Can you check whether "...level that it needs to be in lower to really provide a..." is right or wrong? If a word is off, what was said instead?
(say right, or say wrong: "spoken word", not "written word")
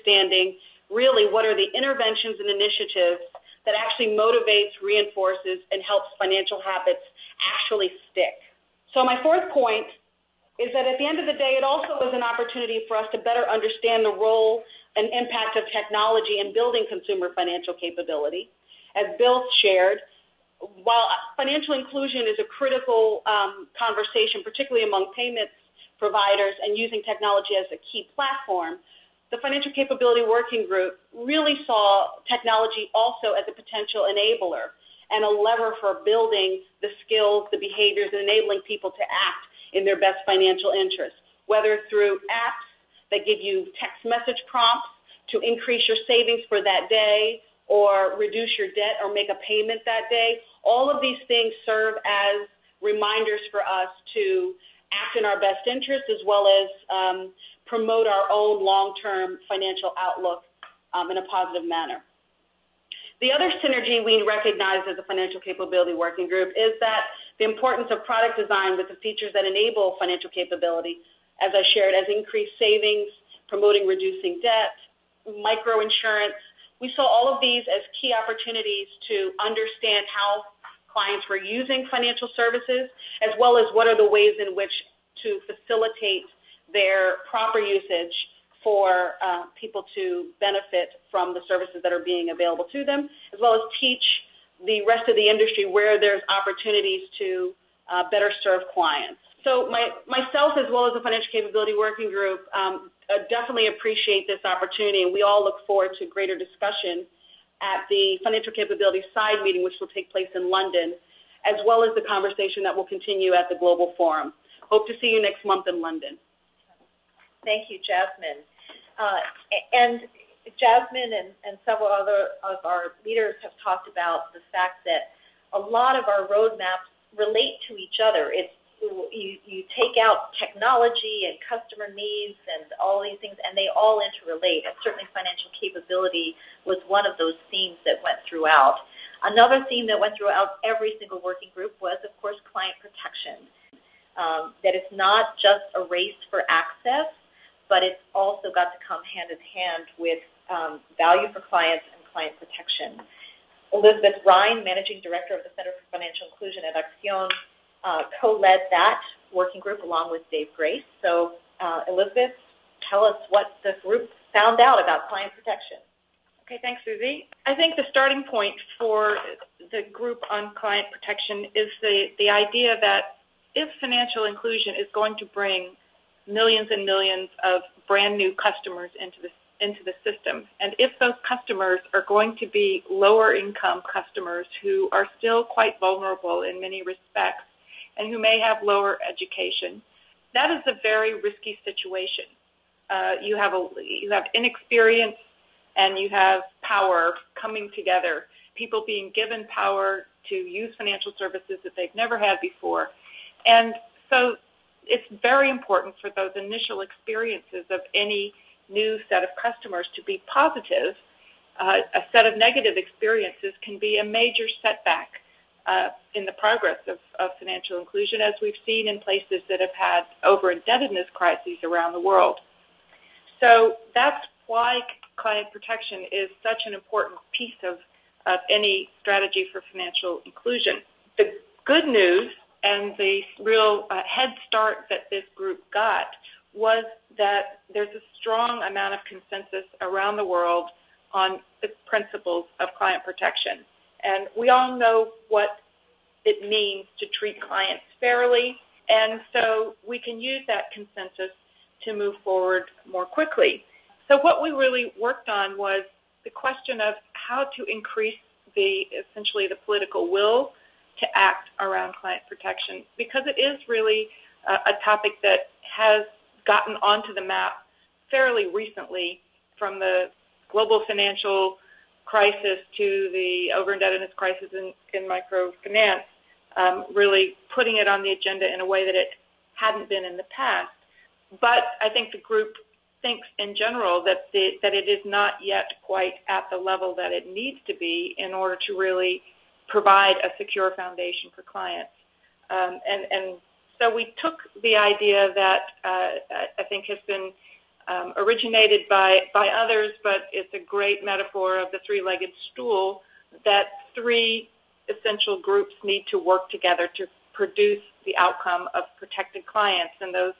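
wrong: "order", not "lower".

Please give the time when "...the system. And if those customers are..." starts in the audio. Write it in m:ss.
2:59.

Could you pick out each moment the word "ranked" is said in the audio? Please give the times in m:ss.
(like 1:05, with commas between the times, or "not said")
not said.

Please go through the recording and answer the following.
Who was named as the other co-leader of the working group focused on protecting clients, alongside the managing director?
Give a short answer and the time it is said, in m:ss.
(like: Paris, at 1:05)
Dave Grace, at 2:40.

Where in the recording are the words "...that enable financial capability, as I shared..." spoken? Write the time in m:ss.
1:09.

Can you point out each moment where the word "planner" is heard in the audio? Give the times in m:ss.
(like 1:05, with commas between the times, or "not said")
not said.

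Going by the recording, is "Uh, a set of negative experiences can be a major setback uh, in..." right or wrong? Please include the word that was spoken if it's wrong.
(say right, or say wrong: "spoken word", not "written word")
right.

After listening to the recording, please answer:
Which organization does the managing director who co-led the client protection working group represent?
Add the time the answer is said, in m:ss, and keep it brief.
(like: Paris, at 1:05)
Acción, at 2:36.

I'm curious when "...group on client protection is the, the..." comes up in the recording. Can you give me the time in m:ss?
2:49.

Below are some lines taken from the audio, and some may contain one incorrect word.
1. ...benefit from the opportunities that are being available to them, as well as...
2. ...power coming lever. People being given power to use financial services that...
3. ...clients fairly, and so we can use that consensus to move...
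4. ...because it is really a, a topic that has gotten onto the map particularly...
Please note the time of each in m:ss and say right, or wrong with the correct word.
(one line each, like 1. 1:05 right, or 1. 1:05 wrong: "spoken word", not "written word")
1. 1:30 wrong: "services", not "opportunities"
2. 3:16 wrong: "together", not "lever"
3. 4:07 right
4. 4:22 wrong: "fairly", not "particularly".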